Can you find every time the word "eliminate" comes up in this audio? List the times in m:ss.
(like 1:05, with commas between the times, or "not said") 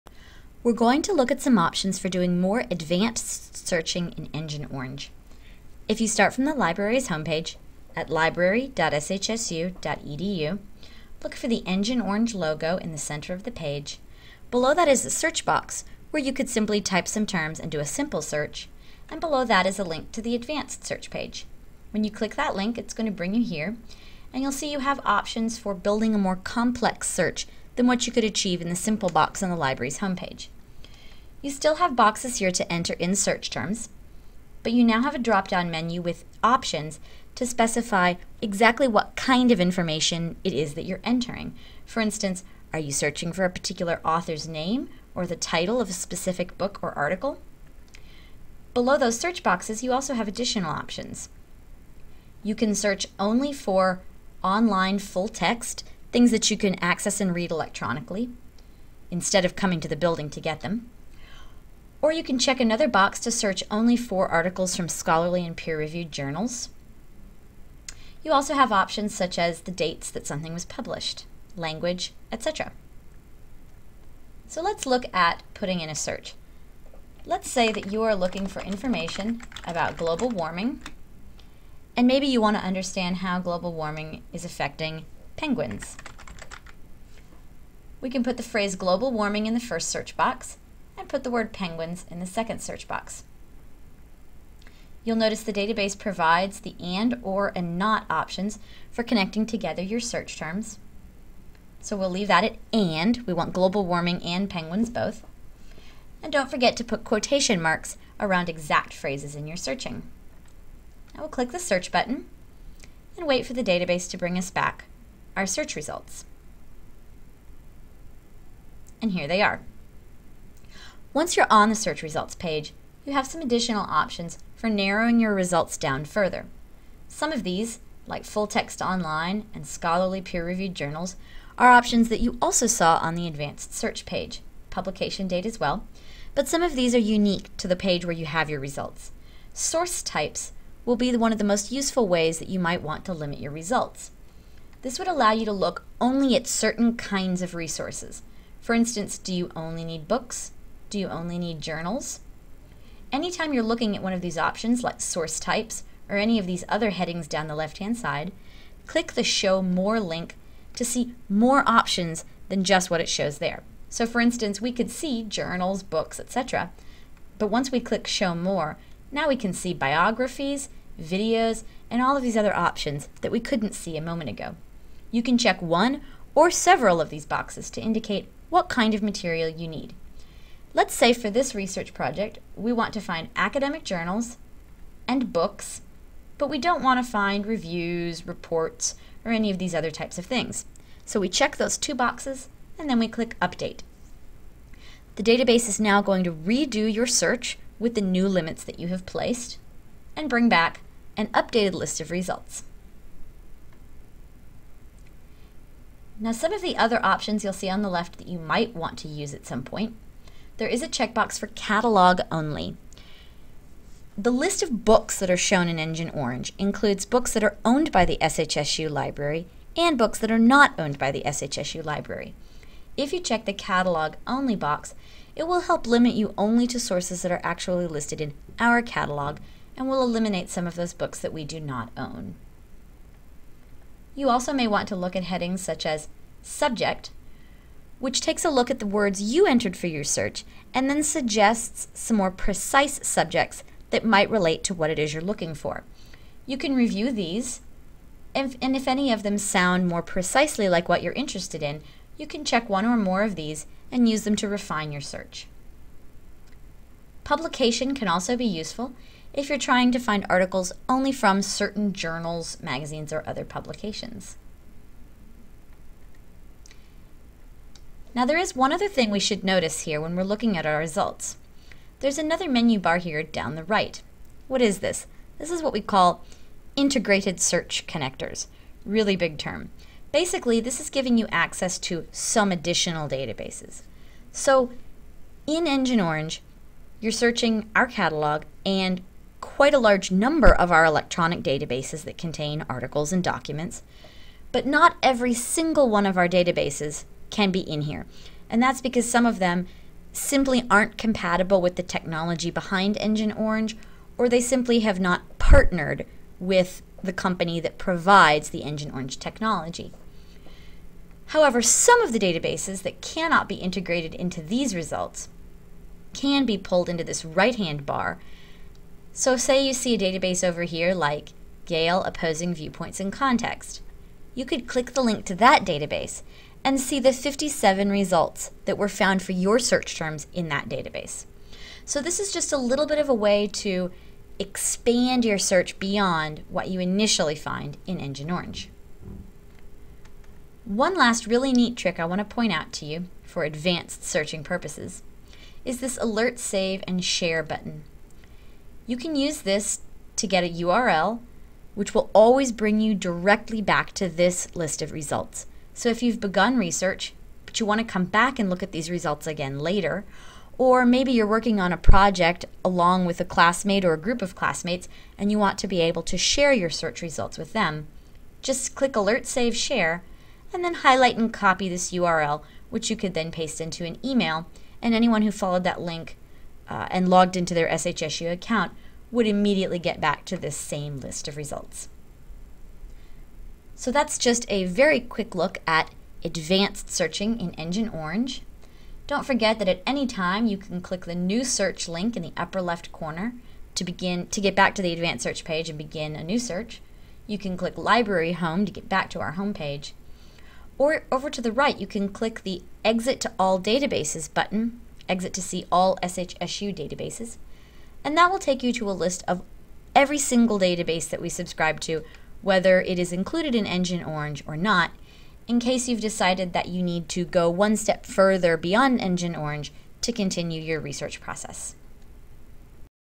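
3:50.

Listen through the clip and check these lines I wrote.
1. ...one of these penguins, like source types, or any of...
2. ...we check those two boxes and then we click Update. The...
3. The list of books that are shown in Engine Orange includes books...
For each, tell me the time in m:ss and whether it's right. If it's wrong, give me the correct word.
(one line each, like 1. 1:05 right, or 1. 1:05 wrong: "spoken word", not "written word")
1. 2:34 wrong: "options", not "penguins"
2. 3:11 right
3. 3:34 right.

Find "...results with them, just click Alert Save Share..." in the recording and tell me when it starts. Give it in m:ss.
6:07.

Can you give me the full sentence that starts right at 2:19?
Source types will be one of the most useful ways that you might want to limit your results.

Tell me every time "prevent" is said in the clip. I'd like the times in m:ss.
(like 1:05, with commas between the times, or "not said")
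not said.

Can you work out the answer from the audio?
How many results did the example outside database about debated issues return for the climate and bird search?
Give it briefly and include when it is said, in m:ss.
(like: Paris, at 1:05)
57, at 5:27.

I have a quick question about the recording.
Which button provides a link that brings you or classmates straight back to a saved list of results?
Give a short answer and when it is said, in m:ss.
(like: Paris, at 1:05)
Alert, save, and share, at 5:45.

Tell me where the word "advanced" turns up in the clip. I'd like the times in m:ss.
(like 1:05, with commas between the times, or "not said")
0:02, 0:20, 2:13, 5:43, 6:26, 6:34.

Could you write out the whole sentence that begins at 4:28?
Now there is one other thing we should notice here when we're looking at our results.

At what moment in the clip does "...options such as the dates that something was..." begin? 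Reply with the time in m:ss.
1:08.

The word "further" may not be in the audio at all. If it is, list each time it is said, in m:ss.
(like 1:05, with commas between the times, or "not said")
2:06, 6:58.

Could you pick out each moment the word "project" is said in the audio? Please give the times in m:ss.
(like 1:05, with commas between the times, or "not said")
3:01, 6:01.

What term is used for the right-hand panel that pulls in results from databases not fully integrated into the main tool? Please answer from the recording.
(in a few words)
Integrated search connectors.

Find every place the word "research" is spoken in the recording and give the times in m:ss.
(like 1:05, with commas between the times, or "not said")
3:01, 5:56, 7:00.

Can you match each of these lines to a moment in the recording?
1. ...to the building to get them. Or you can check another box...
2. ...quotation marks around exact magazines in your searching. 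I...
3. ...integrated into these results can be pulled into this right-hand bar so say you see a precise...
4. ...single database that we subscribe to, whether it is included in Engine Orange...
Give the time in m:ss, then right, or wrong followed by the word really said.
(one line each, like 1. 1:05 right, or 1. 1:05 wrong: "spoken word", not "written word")
1. 0:59 right
2. 1:47 wrong: "phrases", not "magazines"
3. 5:13 wrong: "database", not "precise"
4. 6:50 right.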